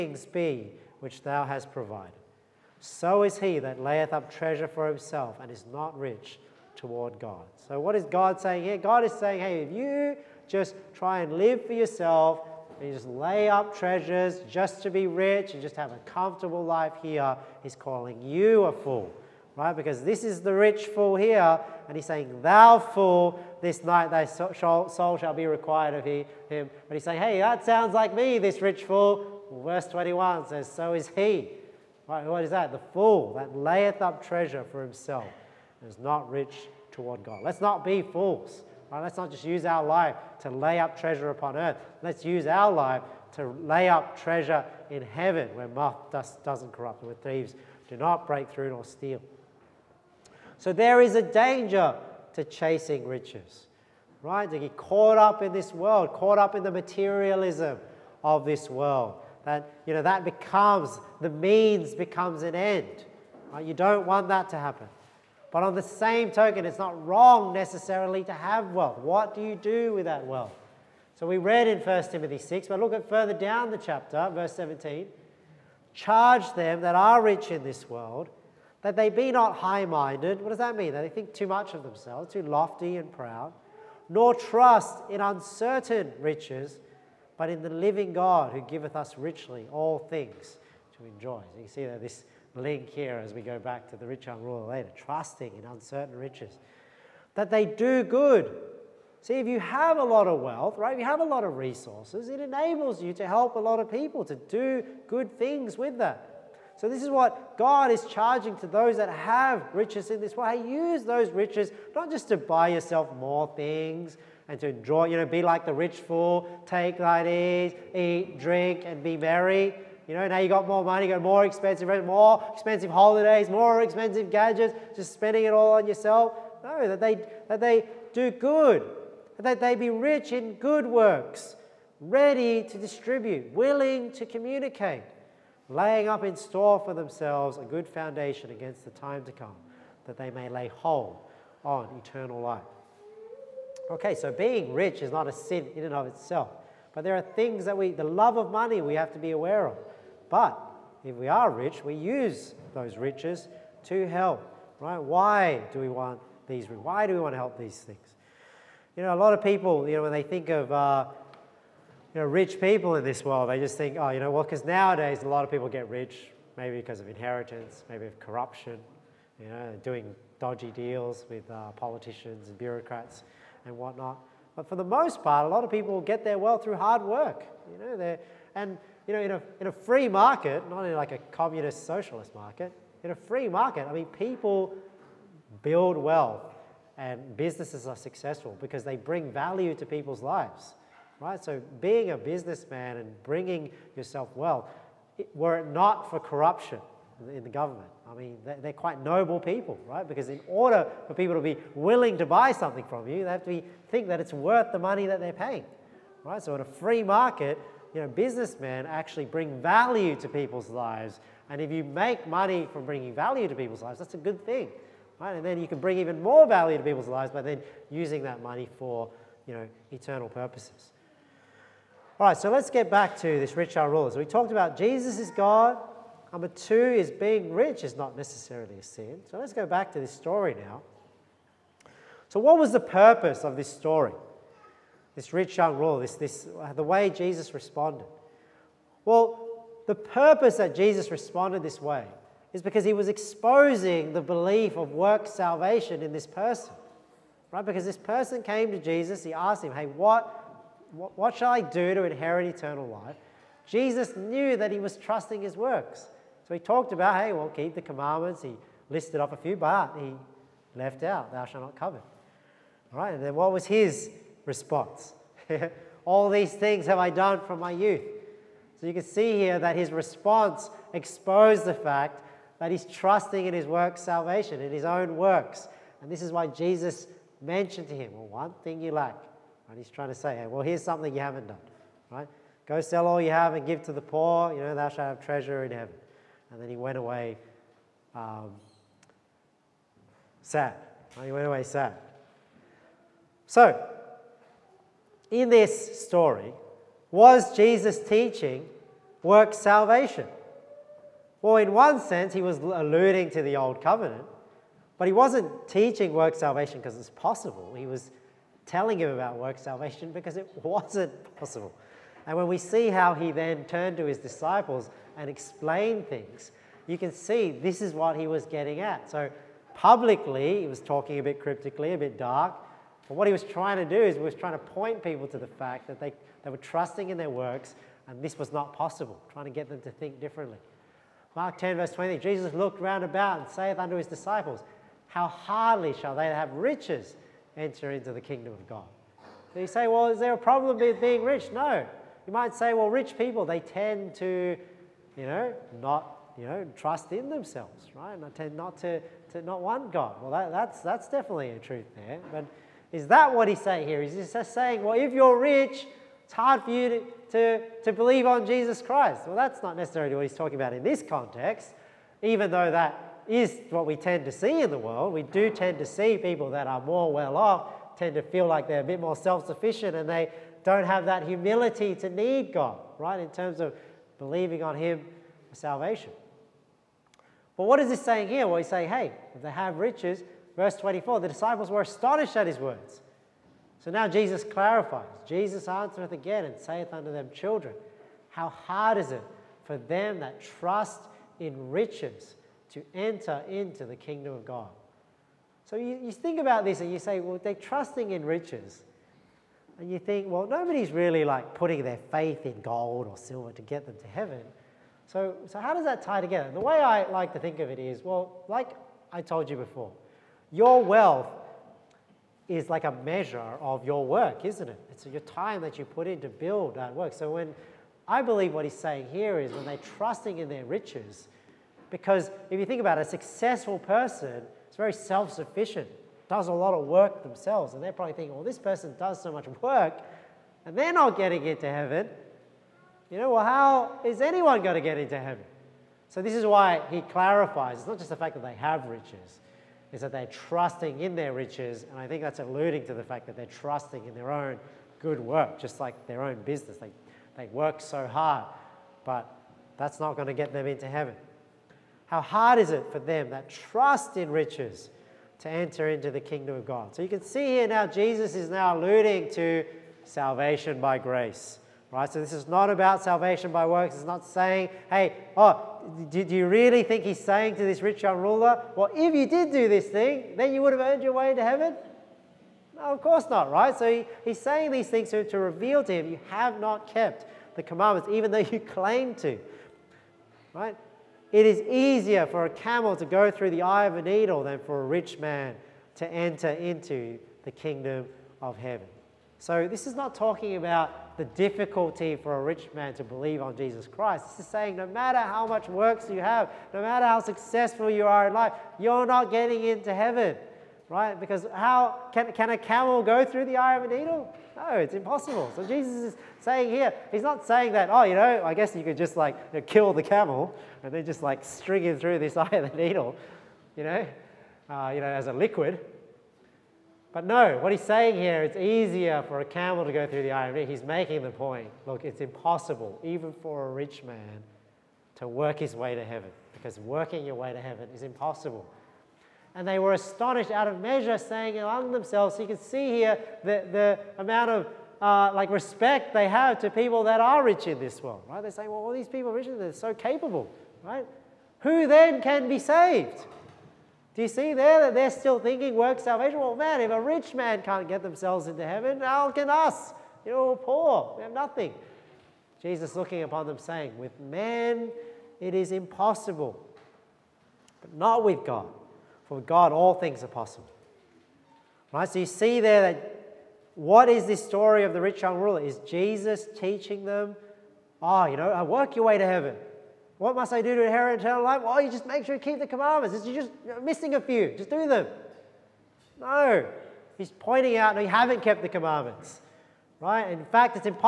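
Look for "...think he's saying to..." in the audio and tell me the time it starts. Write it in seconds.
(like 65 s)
466 s.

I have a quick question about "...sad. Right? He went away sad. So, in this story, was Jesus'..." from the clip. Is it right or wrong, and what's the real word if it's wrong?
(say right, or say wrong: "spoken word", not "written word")
right.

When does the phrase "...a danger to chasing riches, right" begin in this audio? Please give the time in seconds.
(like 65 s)
51 s.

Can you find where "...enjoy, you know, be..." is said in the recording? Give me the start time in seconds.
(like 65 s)
114 s.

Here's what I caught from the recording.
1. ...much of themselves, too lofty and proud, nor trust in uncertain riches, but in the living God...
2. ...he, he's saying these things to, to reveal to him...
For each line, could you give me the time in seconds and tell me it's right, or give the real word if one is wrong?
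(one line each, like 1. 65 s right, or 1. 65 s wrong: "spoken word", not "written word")
1. 81 s right
2. 473 s right.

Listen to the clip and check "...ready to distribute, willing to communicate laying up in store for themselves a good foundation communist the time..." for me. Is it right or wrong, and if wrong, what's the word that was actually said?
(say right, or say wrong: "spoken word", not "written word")
wrong: "against", not "communist".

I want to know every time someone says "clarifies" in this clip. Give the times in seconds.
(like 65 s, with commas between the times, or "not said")
384 s, 437 s.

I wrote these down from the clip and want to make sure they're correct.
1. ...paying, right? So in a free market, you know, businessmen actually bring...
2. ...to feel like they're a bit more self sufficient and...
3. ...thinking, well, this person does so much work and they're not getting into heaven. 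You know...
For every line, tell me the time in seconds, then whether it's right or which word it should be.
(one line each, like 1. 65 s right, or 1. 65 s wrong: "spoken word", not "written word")
1. 205 s right
2. 368 s right
3. 428 s right.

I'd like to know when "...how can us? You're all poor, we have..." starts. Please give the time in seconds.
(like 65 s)
548 s.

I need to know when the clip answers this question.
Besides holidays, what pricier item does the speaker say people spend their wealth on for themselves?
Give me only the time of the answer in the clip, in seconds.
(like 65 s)
124 s.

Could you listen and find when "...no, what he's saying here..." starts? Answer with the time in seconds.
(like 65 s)
517 s.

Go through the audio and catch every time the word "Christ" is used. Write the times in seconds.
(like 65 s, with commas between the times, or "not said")
358 s, 493 s.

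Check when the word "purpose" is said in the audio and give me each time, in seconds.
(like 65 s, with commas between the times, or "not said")
220 s, 232 s, 239 s.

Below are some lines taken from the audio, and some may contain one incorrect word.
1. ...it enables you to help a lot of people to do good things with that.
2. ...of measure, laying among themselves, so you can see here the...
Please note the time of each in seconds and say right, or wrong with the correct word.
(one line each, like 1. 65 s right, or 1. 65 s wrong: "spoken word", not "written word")
1. 102 s right
2. 530 s wrong: "saying", not "laying".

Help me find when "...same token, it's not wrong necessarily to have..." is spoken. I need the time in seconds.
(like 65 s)
65 s.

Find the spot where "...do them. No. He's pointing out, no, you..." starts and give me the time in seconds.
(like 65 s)
574 s.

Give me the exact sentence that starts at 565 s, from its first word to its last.
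Is Jesus teaching them, ah, oh, you know, I work your way to heaven.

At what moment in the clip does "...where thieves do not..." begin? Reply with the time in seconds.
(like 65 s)
47 s.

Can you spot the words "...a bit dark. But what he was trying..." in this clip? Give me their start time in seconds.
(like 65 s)
321 s.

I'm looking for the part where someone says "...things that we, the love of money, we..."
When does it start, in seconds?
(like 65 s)
147 s.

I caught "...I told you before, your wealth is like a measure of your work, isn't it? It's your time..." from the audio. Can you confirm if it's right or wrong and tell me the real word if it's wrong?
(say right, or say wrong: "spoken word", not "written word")
right.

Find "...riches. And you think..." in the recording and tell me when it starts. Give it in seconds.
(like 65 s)
398 s.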